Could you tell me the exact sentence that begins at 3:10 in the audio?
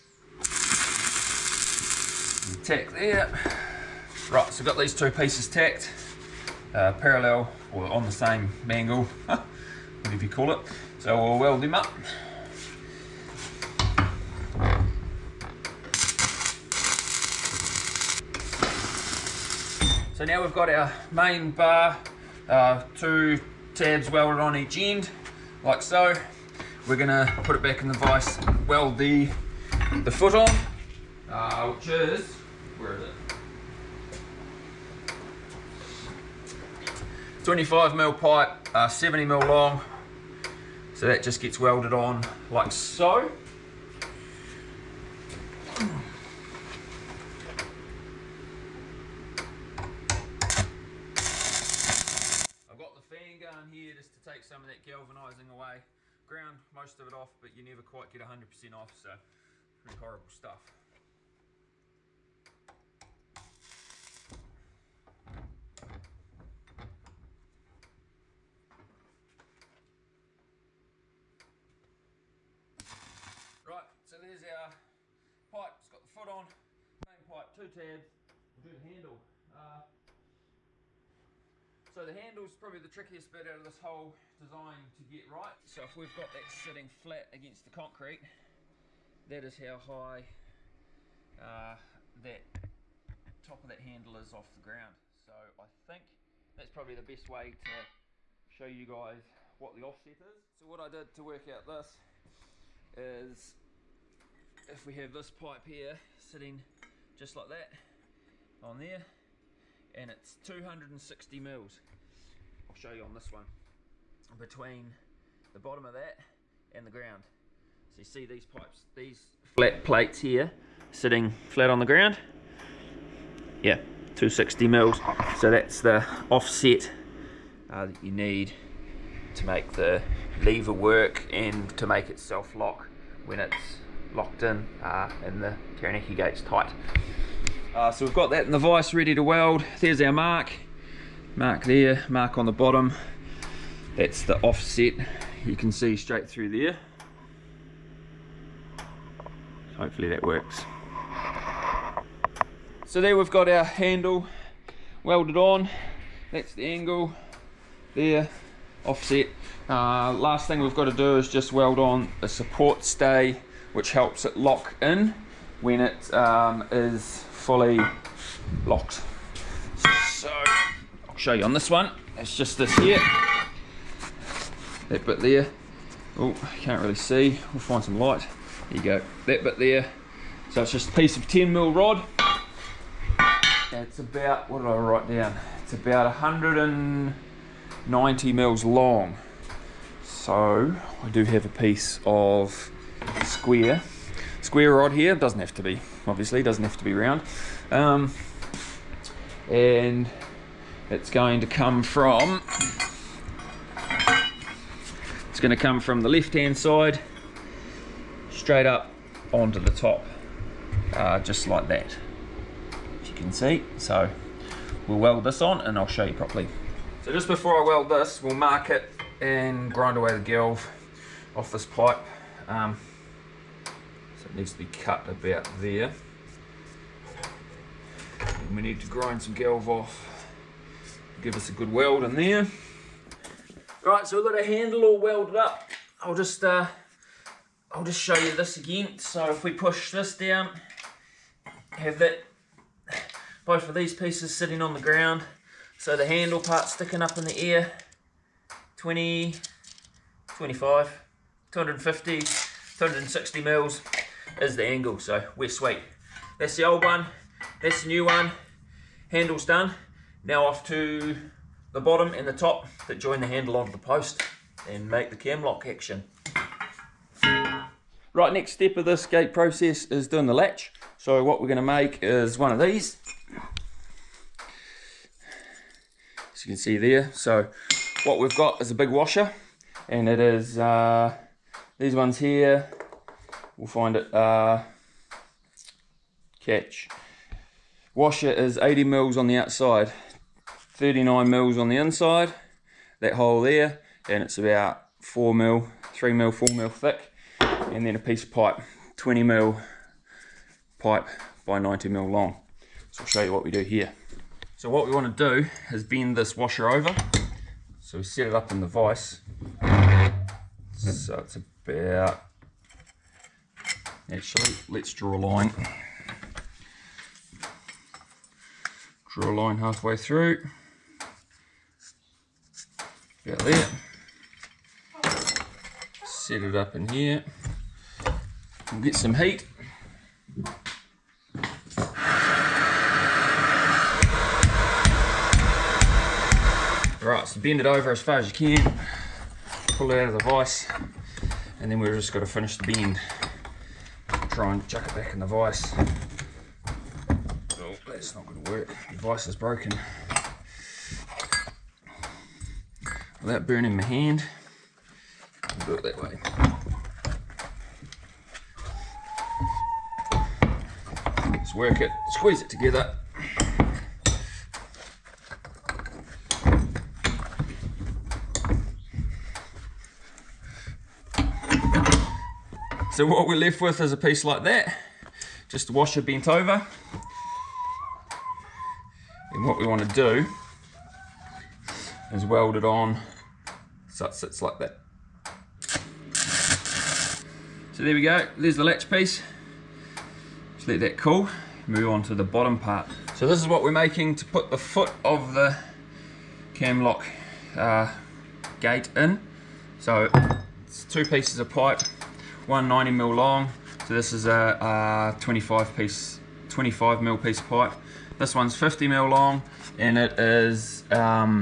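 So I do have a piece of square square rod here.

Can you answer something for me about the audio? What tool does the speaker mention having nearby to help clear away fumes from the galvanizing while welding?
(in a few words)
fan gun.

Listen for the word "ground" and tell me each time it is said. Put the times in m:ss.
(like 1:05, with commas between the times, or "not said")
0:56, 1:34, 1:56, 2:01, 4:04.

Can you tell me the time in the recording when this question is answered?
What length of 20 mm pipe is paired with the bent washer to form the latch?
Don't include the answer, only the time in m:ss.
5:01.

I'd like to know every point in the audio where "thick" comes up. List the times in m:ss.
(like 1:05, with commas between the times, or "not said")
4:56.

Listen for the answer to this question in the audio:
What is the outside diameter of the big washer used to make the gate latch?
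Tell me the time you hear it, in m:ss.
4:48.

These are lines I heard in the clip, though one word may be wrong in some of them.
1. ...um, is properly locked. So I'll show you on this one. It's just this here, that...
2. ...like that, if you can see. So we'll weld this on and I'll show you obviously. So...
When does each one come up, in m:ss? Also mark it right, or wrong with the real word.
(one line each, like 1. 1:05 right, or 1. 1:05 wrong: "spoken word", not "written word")
1. 2:46 wrong: "fully", not "properly"
2. 3:31 wrong: "properly", not "obviously".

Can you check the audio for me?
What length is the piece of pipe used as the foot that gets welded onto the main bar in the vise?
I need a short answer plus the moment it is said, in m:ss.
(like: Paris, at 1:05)
70 mm, at 0:38.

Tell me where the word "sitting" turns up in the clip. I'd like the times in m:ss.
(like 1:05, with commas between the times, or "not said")
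1:26, 1:46, 2:00, 4:04.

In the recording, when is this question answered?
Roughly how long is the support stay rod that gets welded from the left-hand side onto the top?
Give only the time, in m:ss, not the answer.
3:06.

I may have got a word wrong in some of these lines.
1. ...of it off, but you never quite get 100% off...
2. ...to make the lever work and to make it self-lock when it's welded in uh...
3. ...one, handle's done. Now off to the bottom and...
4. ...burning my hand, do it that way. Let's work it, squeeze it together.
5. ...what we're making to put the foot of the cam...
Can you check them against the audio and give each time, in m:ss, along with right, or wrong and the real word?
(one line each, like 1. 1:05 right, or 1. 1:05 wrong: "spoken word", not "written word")
1. 0:56 right
2. 2:09 wrong: "locked", not "welded"
3. 4:18 right
4. 5:53 right
5. 6:33 right.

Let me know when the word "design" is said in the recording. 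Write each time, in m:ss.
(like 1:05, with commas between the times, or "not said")
1:24.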